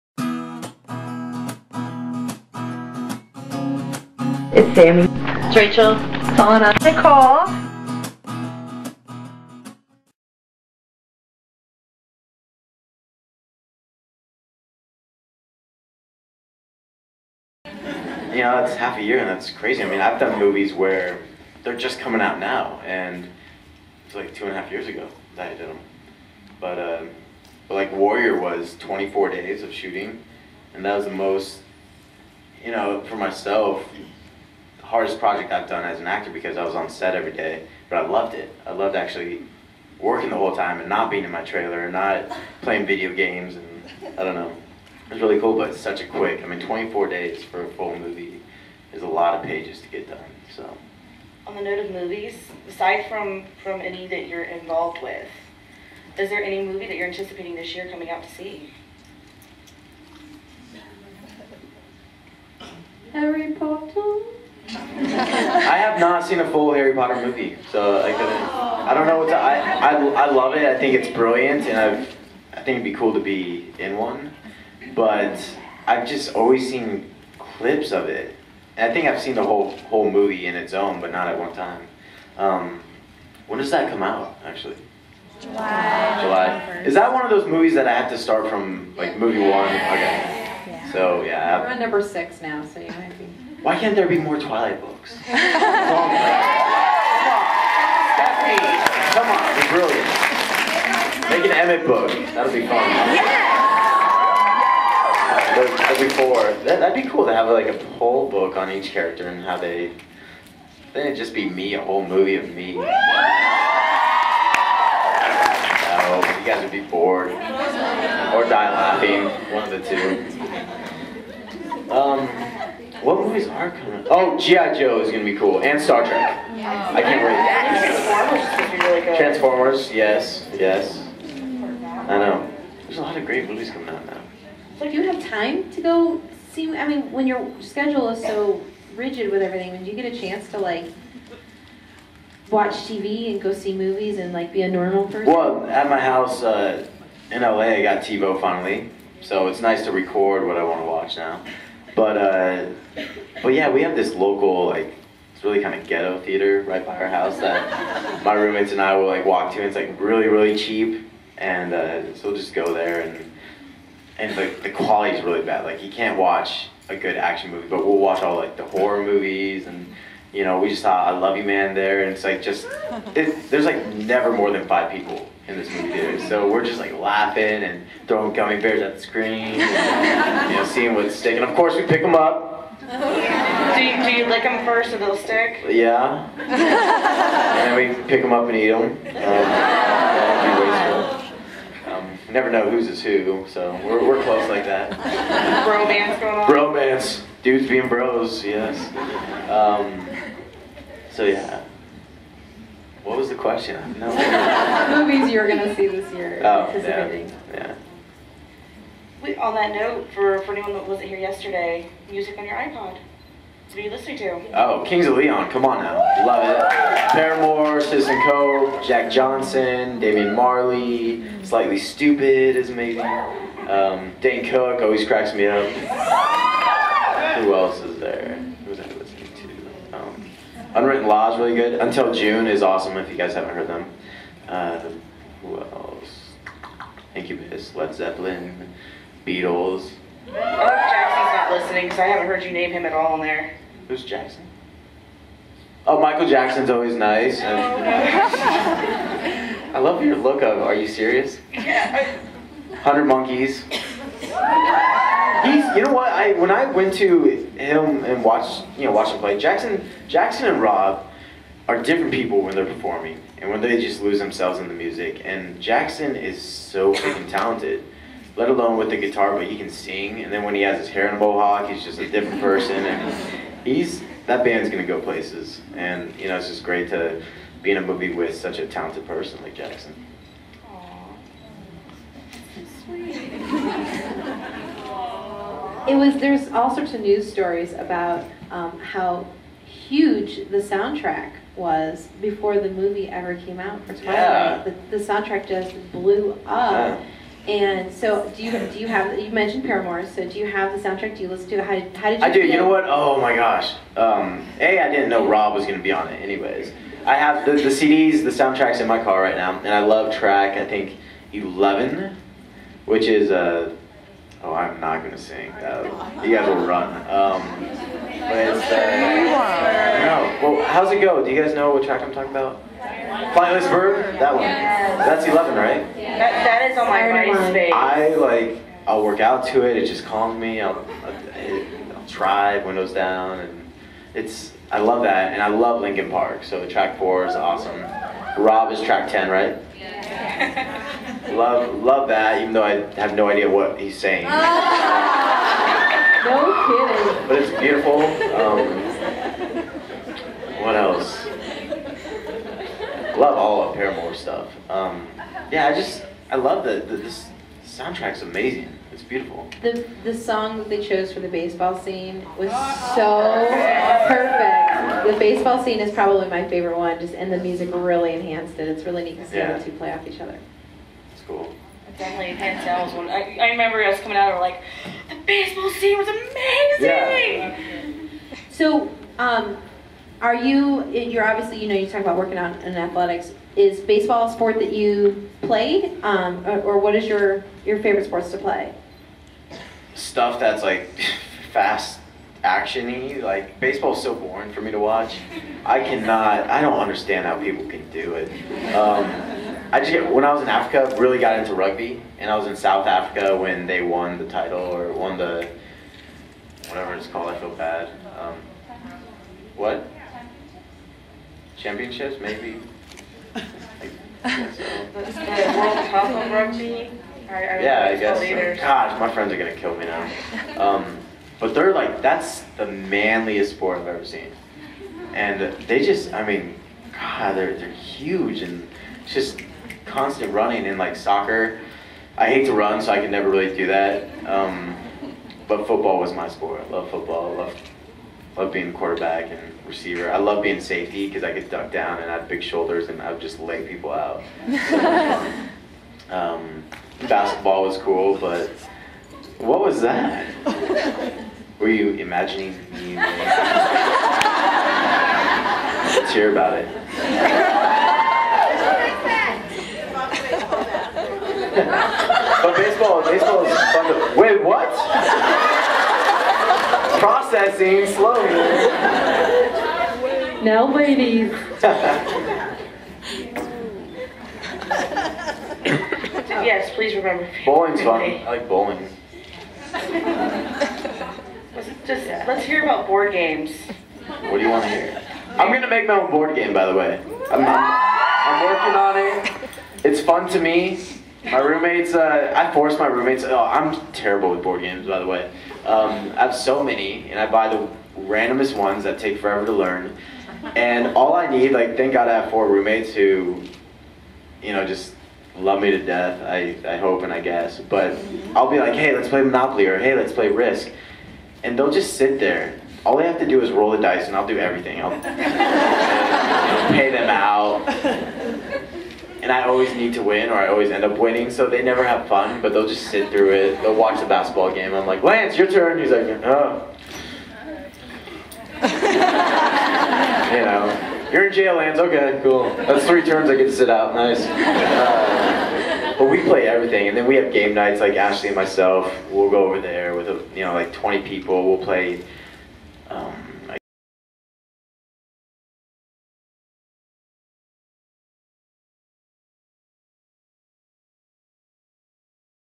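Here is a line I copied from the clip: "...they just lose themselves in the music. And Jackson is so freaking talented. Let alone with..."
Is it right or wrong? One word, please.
right.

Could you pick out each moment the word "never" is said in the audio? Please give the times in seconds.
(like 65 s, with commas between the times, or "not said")
173 s, 192 s, 433 s, 521 s.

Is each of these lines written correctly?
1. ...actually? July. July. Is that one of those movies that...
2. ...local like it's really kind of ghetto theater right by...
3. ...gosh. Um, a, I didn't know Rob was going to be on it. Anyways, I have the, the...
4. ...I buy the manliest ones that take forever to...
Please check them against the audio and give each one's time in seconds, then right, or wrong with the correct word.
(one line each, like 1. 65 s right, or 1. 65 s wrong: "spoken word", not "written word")
1. 84 s right
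2. 154 s right
3. 303 s right
4. 497 s wrong: "randomest", not "manliest".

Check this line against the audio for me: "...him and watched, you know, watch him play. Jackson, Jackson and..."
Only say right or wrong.
right.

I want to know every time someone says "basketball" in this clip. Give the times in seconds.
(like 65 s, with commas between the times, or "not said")
447 s, 524 s.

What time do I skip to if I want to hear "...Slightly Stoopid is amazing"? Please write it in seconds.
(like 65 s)
221 s.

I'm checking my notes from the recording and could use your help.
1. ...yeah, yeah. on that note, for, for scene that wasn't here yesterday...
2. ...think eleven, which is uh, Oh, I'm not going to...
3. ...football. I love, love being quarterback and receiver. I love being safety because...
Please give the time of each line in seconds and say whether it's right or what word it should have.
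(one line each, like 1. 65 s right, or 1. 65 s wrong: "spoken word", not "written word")
1. 206 s wrong: "anyone", not "scene"
2. 310 s right
3. 436 s right.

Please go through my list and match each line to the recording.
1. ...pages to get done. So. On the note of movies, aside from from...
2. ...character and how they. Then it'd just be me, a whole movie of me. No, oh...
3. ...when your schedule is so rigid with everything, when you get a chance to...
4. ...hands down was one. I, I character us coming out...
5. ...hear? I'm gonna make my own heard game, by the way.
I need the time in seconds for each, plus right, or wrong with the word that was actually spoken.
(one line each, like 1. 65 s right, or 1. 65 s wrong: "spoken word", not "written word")
1. 49 s right
2. 108 s right
3. 137 s right
4. 372 s wrong: "remember", not "character"
5. 484 s wrong: "board", not "heard".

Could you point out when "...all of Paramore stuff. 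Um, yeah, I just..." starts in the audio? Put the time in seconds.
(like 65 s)
353 s.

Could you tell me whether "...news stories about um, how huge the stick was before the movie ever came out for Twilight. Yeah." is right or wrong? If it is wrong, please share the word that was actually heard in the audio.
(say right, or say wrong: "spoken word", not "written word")
wrong: "soundtrack", not "stick".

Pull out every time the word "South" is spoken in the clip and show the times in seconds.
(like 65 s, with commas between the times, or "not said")
402 s.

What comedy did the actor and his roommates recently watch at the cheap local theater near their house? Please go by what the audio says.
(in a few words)
I Love You Man.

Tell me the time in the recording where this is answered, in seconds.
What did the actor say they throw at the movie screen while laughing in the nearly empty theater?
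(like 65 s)
178 s.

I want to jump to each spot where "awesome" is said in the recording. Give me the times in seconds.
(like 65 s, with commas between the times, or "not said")
232 s, 337 s.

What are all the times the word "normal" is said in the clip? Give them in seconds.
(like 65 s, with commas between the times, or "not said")
144 s.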